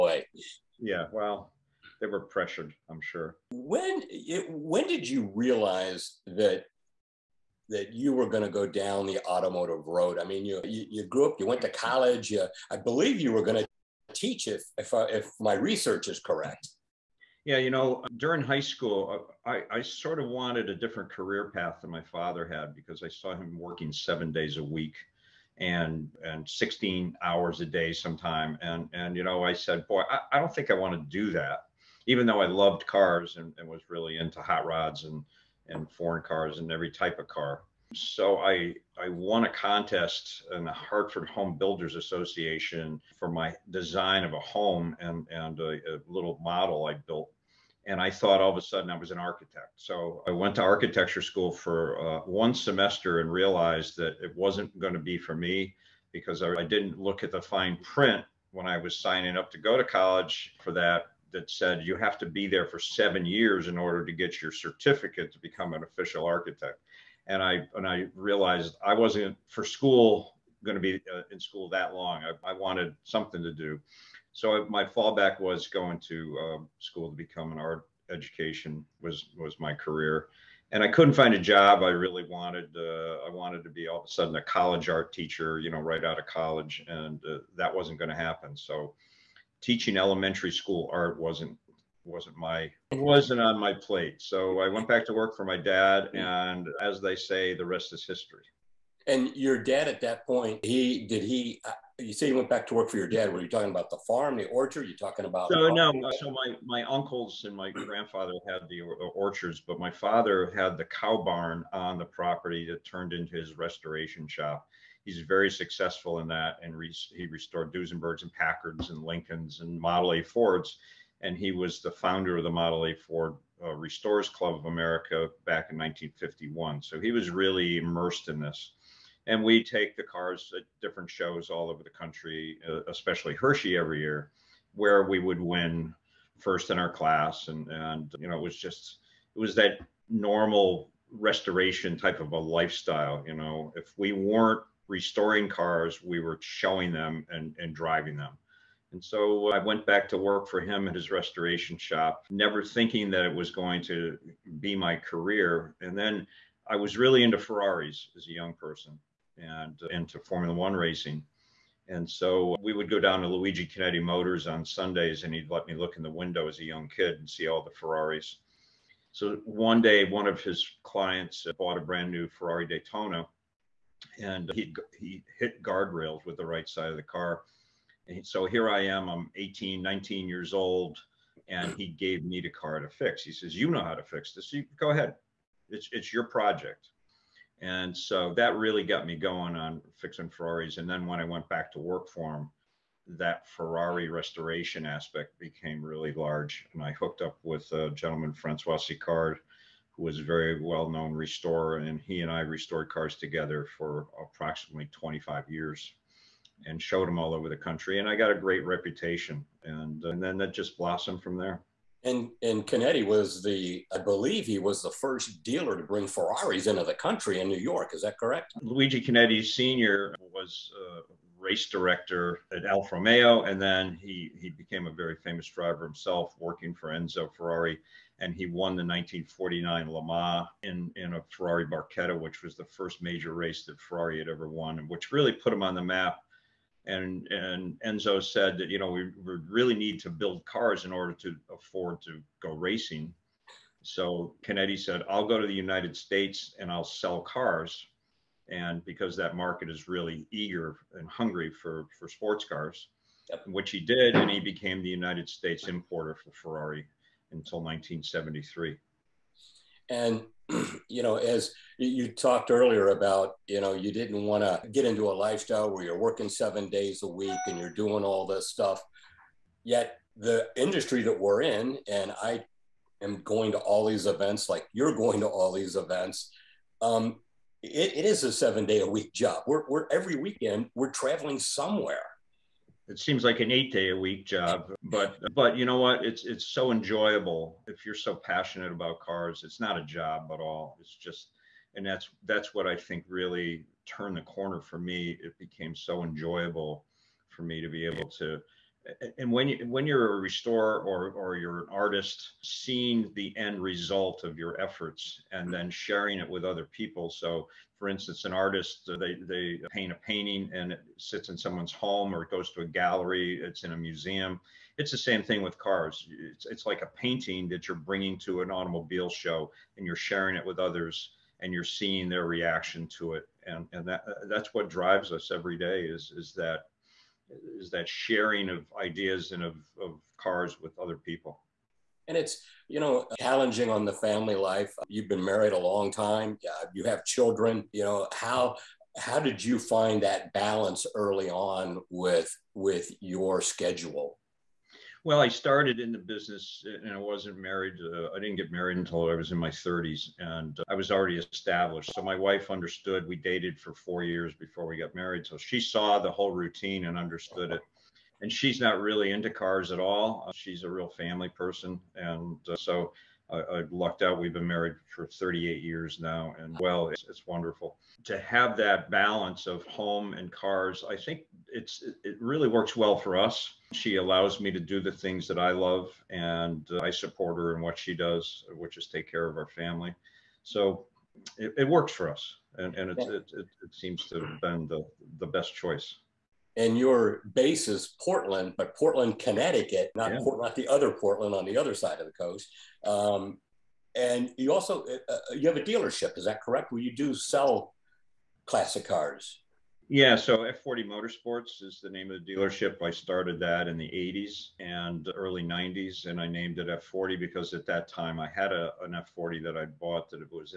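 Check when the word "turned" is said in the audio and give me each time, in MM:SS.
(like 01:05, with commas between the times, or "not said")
01:52, 04:53.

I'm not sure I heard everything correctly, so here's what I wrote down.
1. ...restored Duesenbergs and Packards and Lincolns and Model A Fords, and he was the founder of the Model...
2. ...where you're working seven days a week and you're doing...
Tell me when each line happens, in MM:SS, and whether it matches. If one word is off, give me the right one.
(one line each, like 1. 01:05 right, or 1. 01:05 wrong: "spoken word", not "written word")
1. 01:57 right
2. 04:25 right.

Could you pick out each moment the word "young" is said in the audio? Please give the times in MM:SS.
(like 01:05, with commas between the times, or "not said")
02:38, 02:46.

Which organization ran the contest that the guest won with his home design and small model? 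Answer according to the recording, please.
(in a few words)
Hartford Home Builders Association.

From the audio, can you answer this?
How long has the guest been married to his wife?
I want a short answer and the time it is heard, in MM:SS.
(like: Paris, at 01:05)
38 years, at 06:05.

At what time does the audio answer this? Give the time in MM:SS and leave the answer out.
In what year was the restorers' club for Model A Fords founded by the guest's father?
02:05.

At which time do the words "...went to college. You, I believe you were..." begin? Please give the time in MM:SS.
00:11.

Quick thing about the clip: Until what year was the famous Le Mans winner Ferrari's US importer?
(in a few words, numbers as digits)
1973.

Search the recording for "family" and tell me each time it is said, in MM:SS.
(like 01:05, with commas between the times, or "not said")
05:33, 06:00, 06:19.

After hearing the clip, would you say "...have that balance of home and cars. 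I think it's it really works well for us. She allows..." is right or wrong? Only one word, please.
right.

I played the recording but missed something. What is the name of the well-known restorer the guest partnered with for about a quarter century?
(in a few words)
Francois Sicard.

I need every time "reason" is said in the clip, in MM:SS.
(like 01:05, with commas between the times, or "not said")
not said.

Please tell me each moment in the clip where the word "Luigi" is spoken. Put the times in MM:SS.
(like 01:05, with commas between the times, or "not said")
02:43, 03:38.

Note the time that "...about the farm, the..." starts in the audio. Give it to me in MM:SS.
01:43.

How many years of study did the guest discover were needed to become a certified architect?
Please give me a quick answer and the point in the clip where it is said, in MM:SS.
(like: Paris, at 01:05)
7, at 01:02.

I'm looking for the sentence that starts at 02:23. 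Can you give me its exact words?
You know, if we weren't restoring cars, we were showing them and and driving them.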